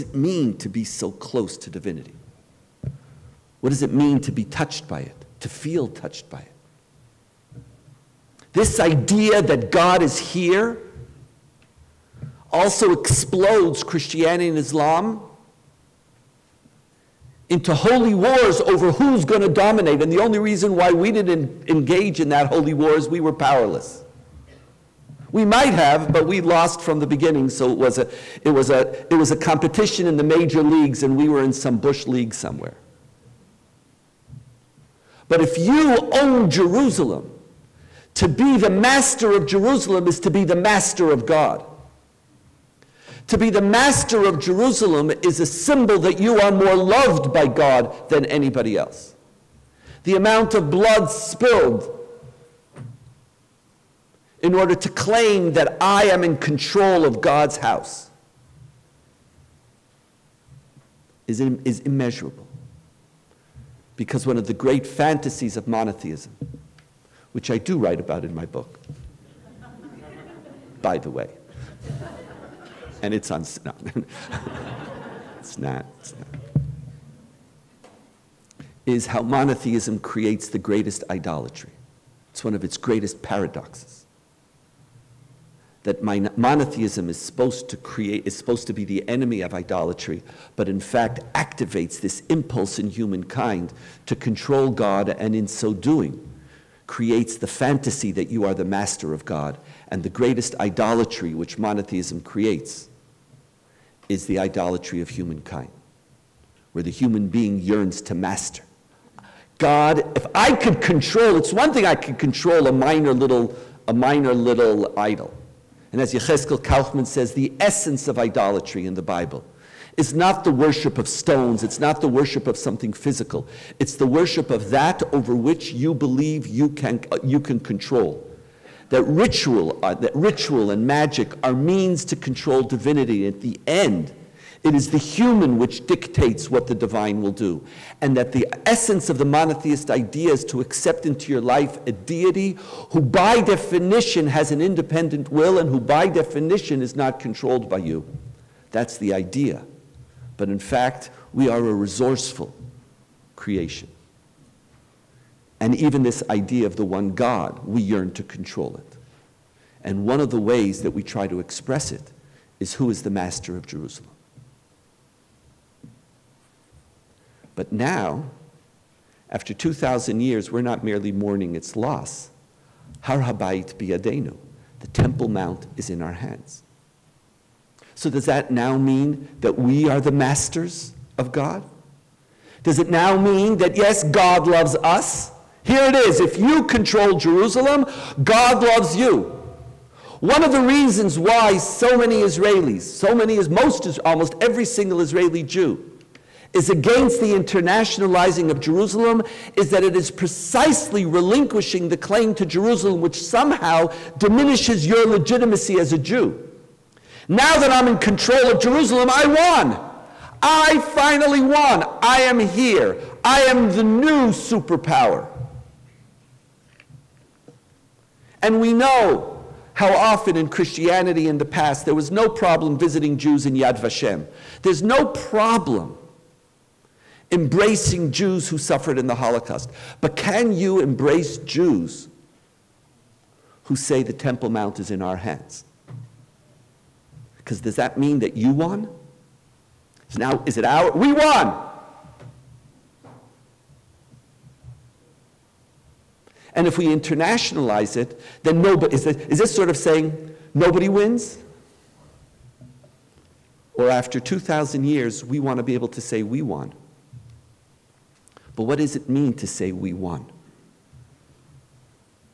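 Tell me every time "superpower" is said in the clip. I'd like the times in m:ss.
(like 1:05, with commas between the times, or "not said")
3:34.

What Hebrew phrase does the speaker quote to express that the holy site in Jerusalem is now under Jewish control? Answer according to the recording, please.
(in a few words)
Har Habayit biyadenu.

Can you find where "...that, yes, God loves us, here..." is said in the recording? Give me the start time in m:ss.
3:03.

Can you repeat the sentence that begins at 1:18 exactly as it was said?
Is how monotheism creates the greatest idolatry.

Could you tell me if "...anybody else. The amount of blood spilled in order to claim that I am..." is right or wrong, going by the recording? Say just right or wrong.
right.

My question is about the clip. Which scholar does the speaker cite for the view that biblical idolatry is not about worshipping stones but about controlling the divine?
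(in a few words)
Yechezkel Kaufmann.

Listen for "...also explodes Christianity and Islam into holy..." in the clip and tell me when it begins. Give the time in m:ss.
0:12.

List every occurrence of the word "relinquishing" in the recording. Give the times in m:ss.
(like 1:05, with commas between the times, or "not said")
3:21.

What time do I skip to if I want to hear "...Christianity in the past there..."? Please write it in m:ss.
3:40.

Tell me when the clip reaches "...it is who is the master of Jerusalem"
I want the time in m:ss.
2:41.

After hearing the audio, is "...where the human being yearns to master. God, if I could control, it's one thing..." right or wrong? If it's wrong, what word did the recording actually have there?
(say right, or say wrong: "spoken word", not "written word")
right.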